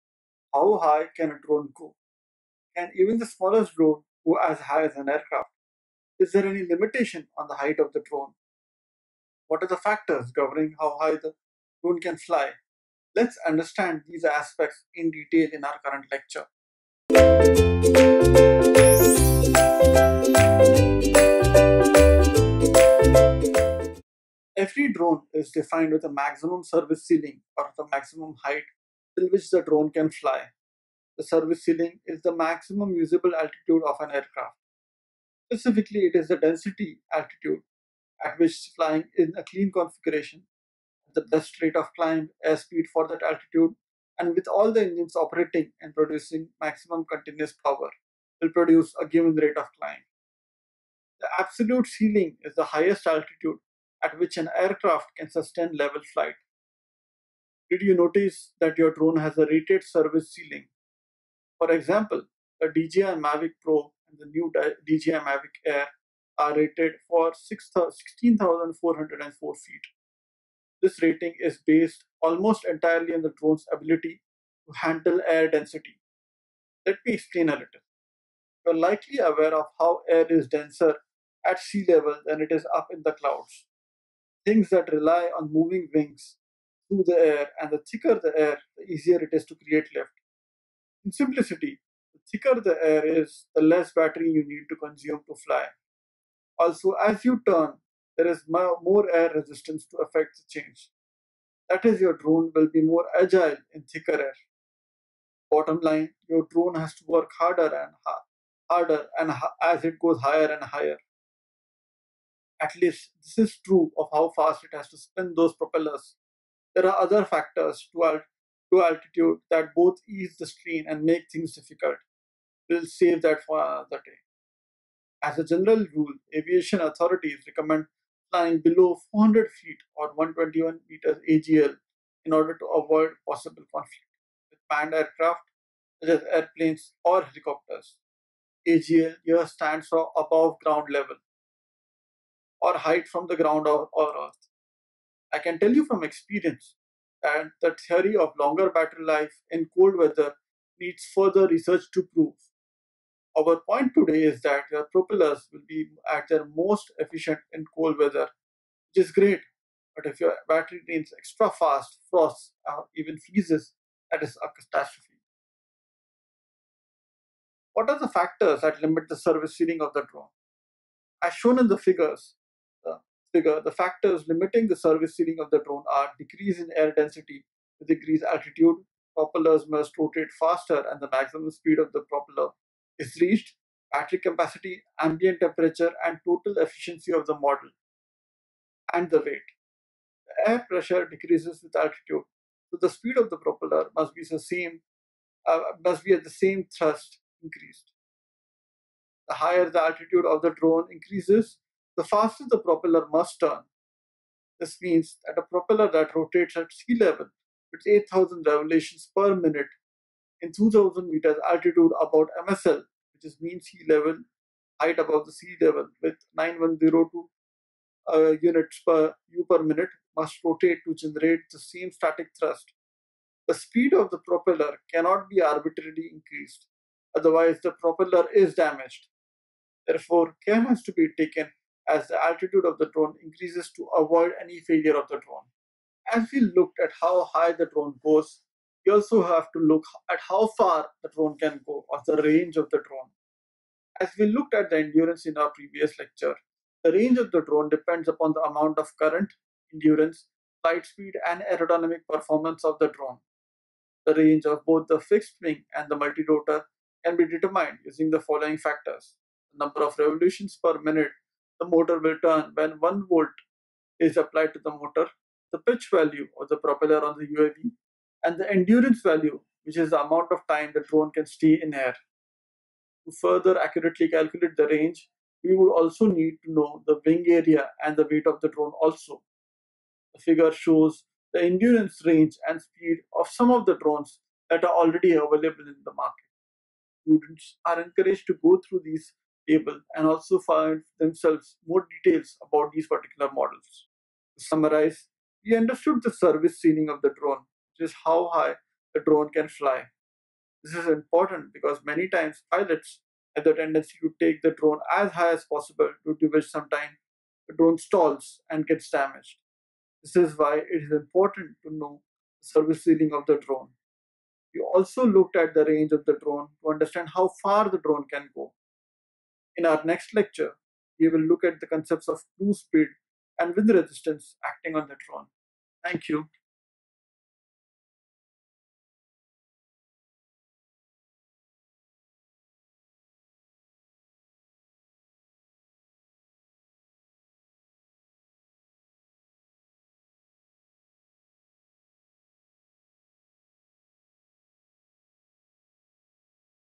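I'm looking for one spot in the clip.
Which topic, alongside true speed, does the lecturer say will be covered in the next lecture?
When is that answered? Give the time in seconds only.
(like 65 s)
323 s.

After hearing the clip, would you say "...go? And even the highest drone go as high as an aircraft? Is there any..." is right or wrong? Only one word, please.
wrong.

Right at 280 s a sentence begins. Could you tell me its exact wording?
The figure shows the endurance range and speed of some of the drones that are already available in the market.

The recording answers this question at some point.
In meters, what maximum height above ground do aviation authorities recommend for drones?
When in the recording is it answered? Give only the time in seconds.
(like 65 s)
130 s.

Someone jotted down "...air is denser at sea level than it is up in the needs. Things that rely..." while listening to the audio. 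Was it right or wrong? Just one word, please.
wrong.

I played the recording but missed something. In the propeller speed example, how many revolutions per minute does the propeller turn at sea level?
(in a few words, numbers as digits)
8,000.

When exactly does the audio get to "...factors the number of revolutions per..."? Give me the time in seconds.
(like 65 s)
258 s.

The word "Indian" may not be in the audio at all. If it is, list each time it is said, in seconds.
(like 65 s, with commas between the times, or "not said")
not said.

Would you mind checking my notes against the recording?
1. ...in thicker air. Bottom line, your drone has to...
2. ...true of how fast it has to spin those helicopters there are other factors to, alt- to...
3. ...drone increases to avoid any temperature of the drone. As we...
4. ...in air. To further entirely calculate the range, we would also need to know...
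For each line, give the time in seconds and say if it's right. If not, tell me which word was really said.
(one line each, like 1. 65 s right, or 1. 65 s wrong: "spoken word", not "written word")
1. 103 s right
2. 113 s wrong: "propellers", not "helicopters"
3. 232 s wrong: "failure", not "temperature"
4. 271 s wrong: "accurately", not "entirely".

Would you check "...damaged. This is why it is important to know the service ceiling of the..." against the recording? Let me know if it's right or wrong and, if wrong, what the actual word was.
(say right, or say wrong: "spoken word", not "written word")
right.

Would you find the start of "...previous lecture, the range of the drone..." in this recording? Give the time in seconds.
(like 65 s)
245 s.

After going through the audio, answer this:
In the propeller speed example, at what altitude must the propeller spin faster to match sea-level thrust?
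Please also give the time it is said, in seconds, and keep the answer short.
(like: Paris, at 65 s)
2,000 meters, at 210 s.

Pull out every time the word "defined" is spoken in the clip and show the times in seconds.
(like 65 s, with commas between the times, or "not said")
25 s.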